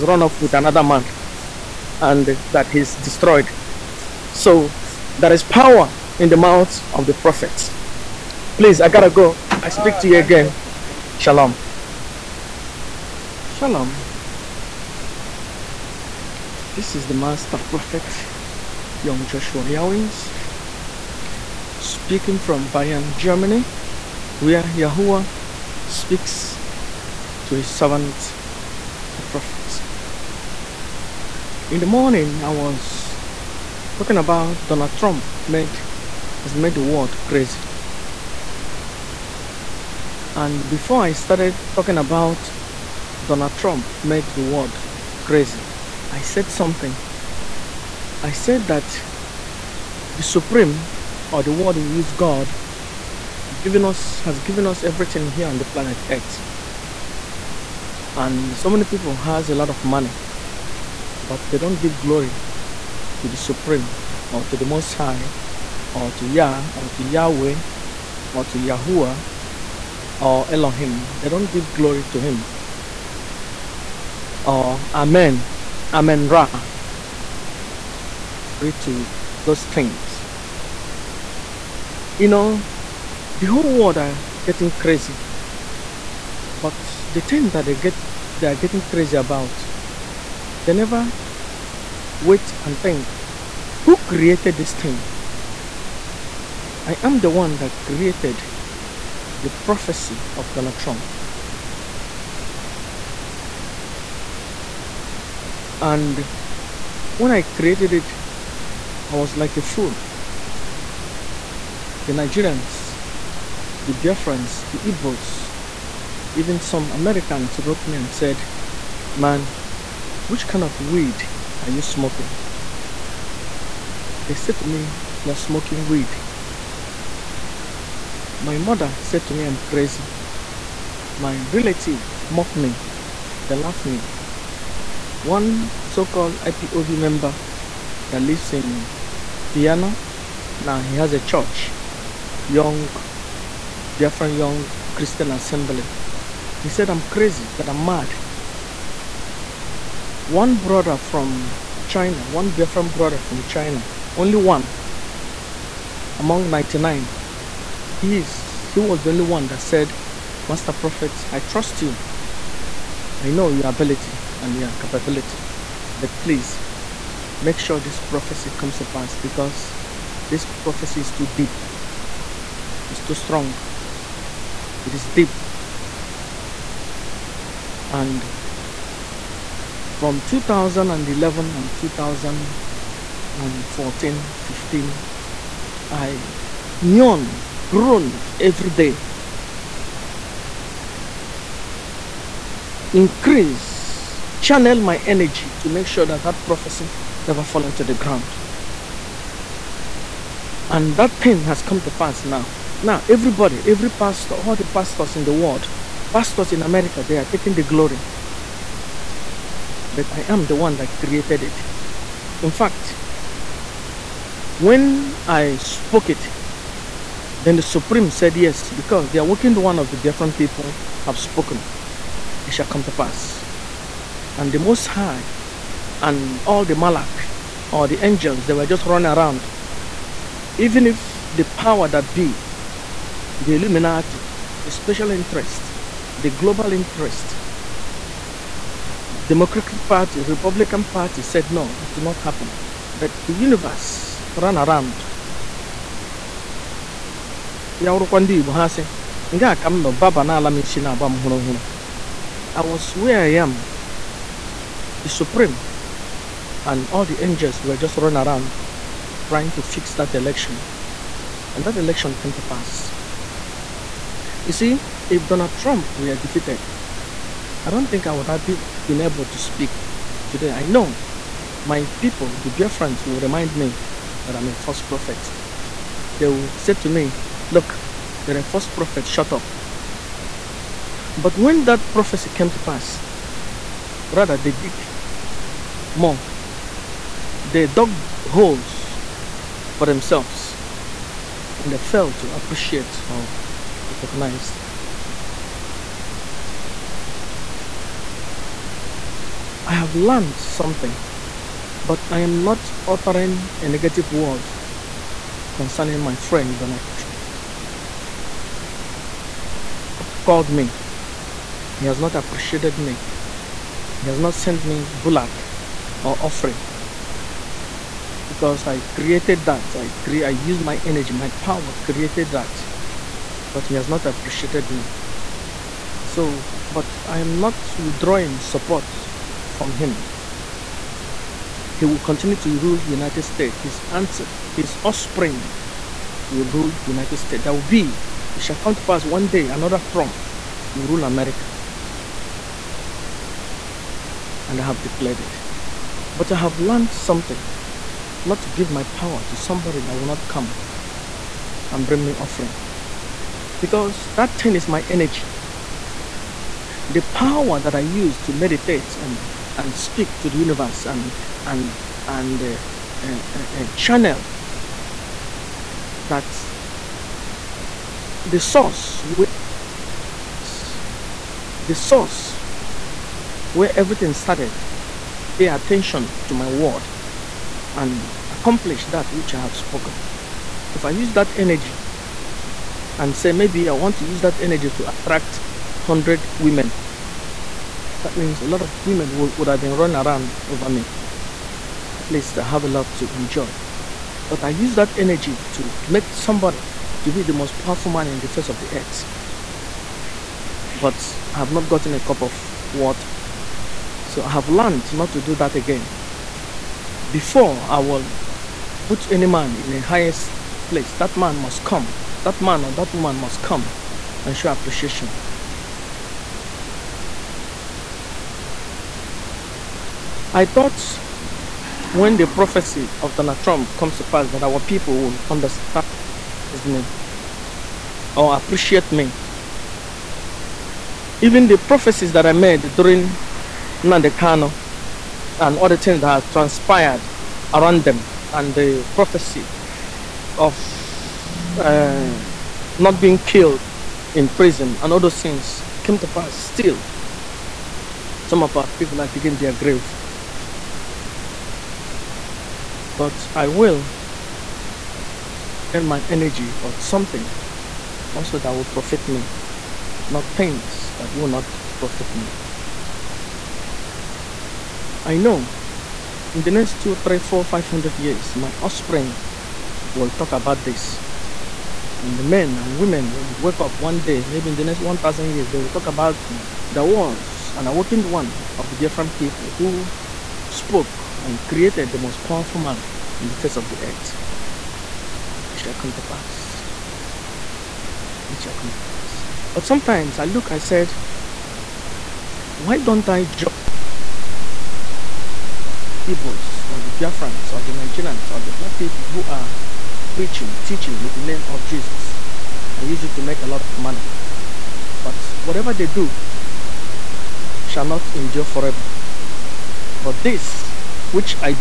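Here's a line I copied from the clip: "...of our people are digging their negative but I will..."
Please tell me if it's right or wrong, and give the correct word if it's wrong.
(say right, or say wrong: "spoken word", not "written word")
wrong: "grave", not "negative".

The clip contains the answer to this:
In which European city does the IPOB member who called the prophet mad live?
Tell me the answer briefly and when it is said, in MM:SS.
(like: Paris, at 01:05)
Vienna, at 02:19.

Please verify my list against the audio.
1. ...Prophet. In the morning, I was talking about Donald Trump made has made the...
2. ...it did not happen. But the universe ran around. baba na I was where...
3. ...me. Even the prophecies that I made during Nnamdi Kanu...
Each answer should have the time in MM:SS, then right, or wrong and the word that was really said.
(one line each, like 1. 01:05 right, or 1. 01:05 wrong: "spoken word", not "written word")
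1. 00:29 right
2. 04:01 right
3. 07:08 right.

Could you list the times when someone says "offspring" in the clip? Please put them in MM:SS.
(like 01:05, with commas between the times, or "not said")
05:34, 07:48.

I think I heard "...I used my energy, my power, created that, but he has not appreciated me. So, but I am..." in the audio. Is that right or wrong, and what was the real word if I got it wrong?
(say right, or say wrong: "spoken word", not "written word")
right.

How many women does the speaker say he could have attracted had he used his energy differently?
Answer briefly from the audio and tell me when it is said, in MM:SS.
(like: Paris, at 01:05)
100, at 06:25.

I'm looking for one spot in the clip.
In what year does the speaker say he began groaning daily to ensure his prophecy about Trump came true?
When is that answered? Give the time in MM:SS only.
03:00.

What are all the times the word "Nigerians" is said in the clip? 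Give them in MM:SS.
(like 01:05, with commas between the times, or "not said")
01:52, 08:17.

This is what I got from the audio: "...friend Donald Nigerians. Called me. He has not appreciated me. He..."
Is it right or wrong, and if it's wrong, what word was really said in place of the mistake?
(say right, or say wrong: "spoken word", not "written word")
wrong: "Trump", not "Nigerians".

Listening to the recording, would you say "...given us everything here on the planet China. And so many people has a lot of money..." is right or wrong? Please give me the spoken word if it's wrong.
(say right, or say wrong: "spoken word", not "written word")
wrong: "Earth", not "China".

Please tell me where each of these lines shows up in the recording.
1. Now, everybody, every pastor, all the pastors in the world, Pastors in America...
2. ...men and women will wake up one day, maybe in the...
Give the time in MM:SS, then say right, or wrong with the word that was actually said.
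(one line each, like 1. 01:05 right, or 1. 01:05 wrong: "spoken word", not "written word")
1. 03:22 right
2. 07:52 right.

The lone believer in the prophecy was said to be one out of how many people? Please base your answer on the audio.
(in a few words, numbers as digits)
99.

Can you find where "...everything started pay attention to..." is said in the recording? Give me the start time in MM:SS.
06:13.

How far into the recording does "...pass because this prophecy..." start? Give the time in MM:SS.
02:48.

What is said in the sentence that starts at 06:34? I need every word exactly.
But I use that energy to make somebody to be the most powerful man in the face of the earth.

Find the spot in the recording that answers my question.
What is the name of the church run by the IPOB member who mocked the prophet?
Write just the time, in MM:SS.
02:23.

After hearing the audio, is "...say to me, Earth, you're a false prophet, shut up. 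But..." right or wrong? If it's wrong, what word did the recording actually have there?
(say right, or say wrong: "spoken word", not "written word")
wrong: "Look", not "Earth".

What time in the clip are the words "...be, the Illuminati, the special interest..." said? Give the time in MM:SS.
03:52.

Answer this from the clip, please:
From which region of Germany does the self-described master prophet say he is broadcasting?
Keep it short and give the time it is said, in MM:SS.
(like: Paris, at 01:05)
Bayern, at 00:22.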